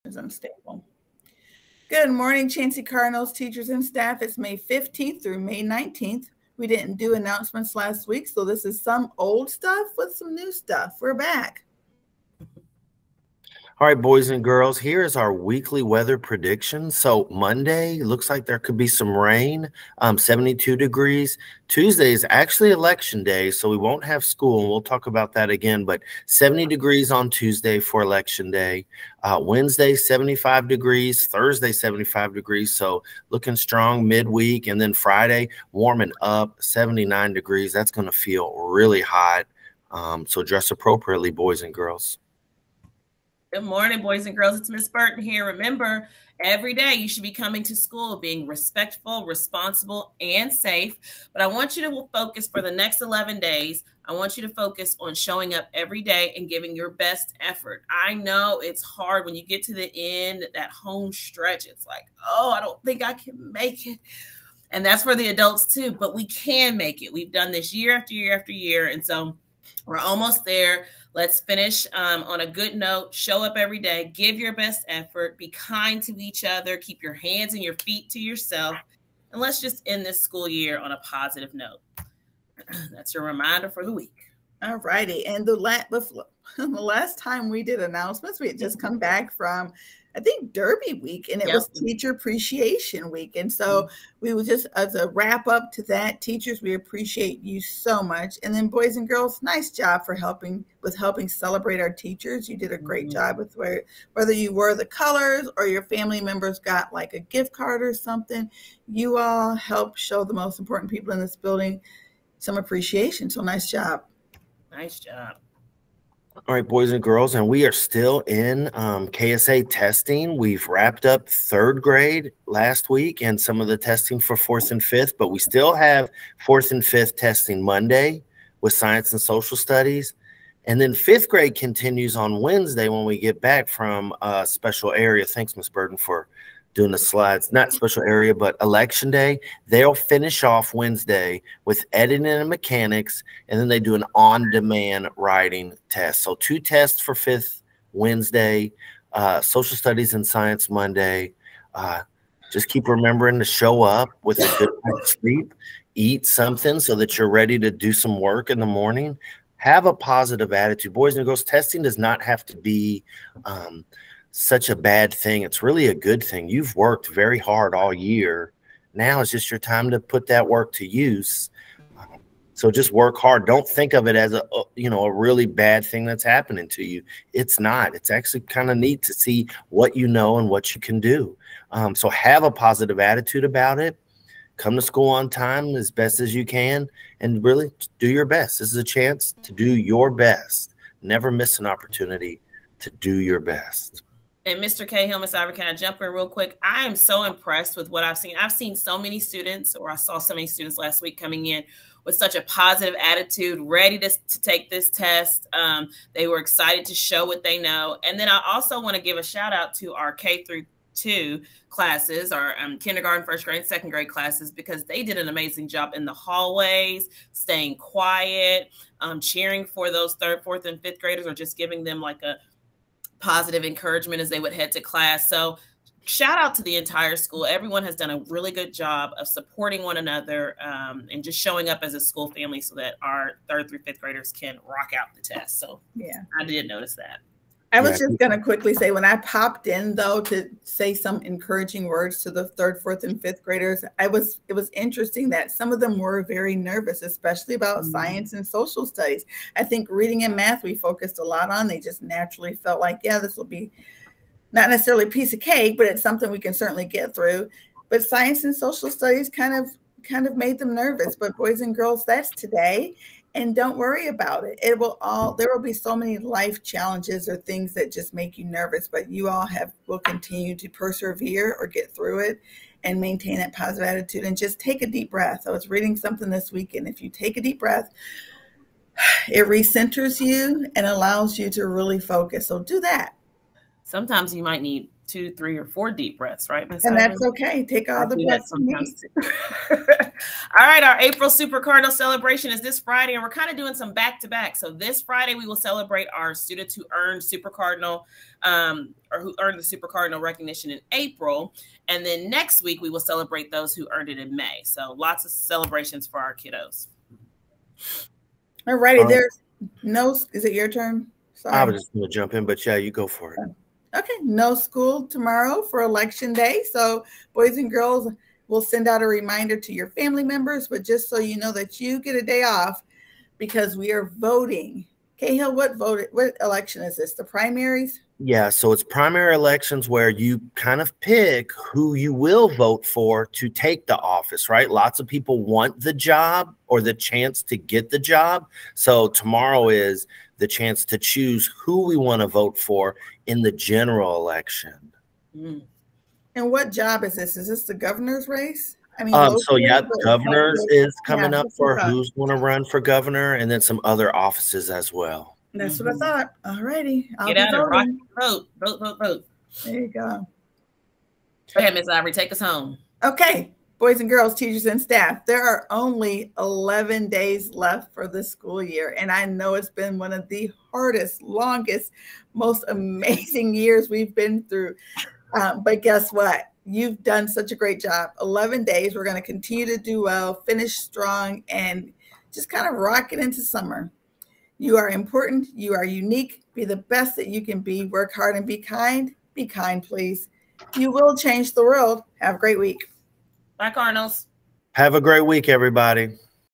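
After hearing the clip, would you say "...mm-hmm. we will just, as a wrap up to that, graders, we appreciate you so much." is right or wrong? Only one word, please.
wrong.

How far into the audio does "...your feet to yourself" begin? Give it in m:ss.
1:17.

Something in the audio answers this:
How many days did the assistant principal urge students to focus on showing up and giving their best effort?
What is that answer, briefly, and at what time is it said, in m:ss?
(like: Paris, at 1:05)
11 days, at 0:52.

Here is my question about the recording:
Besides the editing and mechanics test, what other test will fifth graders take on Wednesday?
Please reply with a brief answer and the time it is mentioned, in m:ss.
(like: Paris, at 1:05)
on demand writing, at 2:24.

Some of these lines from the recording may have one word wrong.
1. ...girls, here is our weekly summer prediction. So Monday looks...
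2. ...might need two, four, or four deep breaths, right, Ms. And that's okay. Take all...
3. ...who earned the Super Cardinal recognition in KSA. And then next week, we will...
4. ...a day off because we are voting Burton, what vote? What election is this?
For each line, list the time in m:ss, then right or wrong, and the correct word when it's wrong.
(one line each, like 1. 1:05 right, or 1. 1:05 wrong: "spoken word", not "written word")
1. 0:14 wrong: "weather", not "summer"
2. 4:44 wrong: "three", not "four"
3. 4:59 wrong: "April", not "KSA"
4. 5:22 wrong: "Cahill", not "Burton".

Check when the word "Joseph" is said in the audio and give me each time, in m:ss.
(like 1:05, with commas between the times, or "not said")
not said.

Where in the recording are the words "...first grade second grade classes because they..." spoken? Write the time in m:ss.
3:33.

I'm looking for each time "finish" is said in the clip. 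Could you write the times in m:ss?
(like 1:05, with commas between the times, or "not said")
1:11, 2:19, 6:20.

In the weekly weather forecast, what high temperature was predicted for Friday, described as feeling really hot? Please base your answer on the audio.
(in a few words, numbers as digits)
79 degrees.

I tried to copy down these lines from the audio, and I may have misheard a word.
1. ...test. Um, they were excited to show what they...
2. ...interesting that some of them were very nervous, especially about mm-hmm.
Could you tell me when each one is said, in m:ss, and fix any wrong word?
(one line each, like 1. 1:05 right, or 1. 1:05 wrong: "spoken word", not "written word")
1. 3:24 right
2. 4:04 right.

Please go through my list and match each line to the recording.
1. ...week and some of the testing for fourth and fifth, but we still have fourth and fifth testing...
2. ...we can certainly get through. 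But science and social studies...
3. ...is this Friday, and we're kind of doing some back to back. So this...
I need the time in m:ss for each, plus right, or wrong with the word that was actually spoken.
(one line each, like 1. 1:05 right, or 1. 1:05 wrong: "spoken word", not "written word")
1. 2:02 right
2. 4:16 right
3. 4:52 right.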